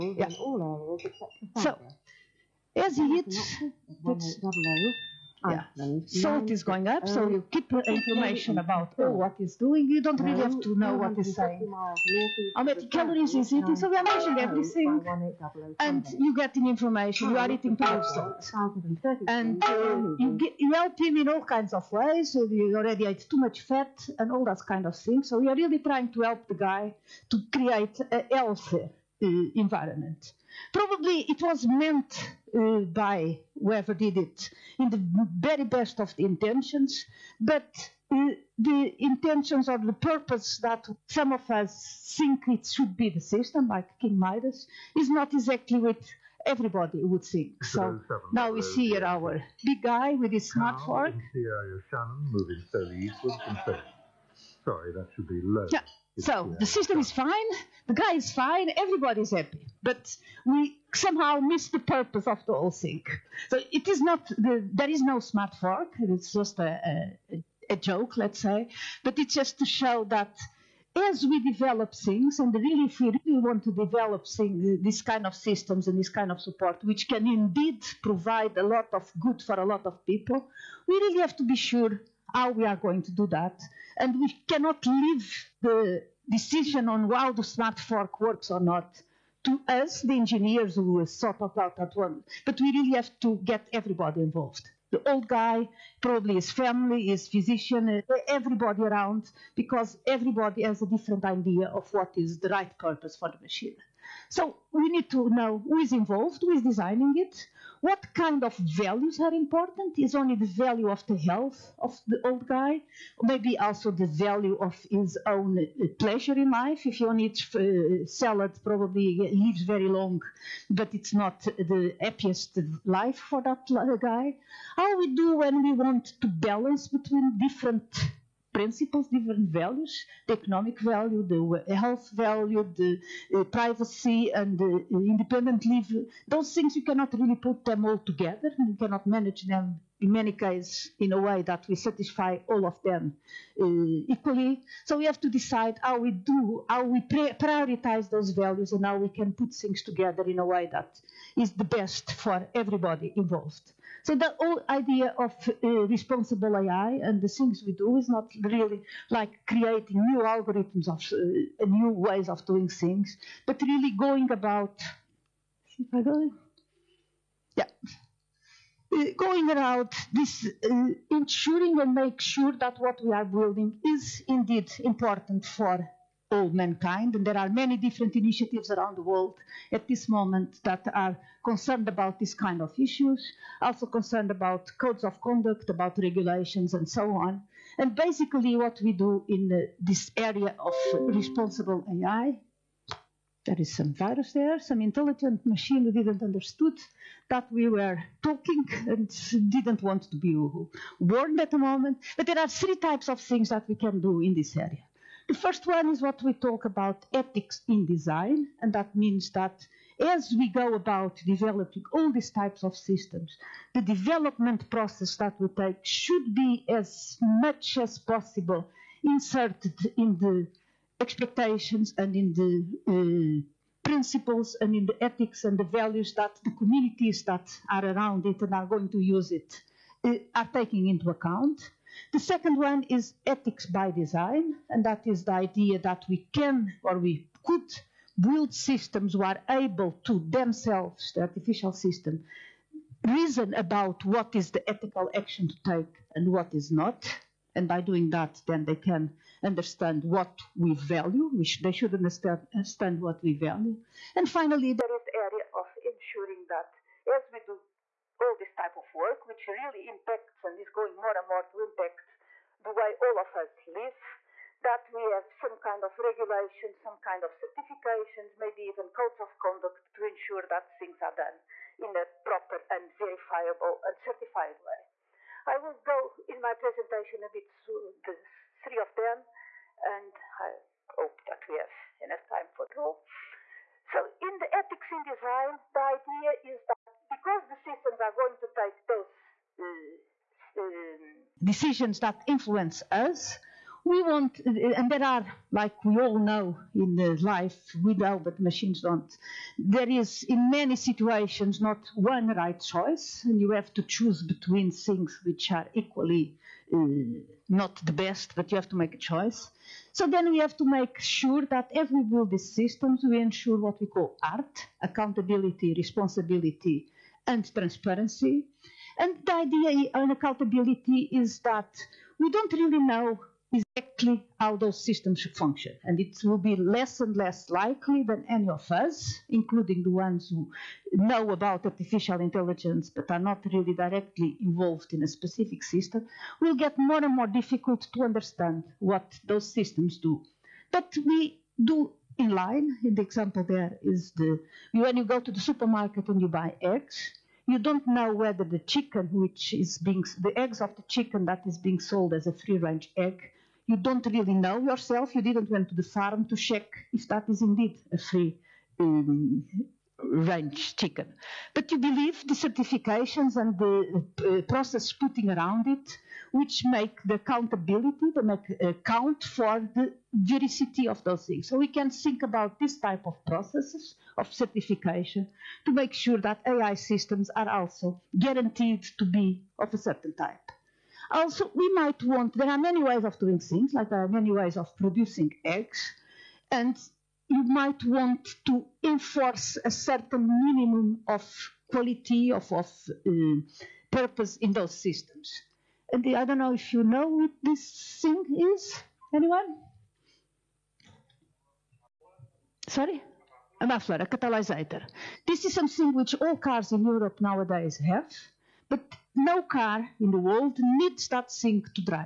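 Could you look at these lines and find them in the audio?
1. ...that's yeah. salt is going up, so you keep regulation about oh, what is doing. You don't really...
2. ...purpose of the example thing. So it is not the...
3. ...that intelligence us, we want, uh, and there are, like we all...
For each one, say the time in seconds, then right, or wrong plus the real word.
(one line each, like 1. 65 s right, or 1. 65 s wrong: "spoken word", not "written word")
1. 4 s wrong: "information", not "regulation"
2. 61 s wrong: "whole", not "example"
3. 291 s wrong: "influence", not "intelligence".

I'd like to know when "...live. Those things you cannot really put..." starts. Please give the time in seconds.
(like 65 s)
135 s.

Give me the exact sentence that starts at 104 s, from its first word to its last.
So we need to know who is involved, who is designing it, what kind of values are important?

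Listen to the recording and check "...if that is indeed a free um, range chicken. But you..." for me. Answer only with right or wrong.
right.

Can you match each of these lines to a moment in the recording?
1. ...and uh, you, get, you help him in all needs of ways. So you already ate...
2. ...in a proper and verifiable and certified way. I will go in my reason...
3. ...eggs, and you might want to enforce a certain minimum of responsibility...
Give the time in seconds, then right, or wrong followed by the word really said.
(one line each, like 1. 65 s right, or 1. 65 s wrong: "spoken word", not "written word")
1. 19 s wrong: "kinds", not "needs"
2. 271 s wrong: "presentation", not "reason"
3. 385 s wrong: "quality", not "responsibility".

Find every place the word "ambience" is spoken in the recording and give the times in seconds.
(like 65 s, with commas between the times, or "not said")
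not said.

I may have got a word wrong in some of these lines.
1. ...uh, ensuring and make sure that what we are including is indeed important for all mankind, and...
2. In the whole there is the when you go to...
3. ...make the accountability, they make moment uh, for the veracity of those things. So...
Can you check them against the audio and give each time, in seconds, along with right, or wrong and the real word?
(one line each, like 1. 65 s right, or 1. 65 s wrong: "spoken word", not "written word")
1. 170 s wrong: "building", not "including"
2. 342 s wrong: "example", not "whole"
3. 366 s wrong: "account", not "moment".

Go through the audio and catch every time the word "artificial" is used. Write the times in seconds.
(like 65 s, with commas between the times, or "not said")
241 s, 331 s.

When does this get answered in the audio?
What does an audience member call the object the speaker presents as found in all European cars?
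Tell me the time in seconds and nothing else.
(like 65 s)
403 s.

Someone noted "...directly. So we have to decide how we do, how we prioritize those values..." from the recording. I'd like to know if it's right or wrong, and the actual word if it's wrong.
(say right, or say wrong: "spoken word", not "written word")
wrong: "equally", not "directly".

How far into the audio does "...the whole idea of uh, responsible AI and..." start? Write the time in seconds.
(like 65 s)
154 s.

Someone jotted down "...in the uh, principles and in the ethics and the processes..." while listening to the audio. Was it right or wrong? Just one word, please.
wrong.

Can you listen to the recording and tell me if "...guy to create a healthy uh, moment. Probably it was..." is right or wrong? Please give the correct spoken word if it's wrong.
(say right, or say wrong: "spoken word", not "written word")
wrong: "environment", not "moment".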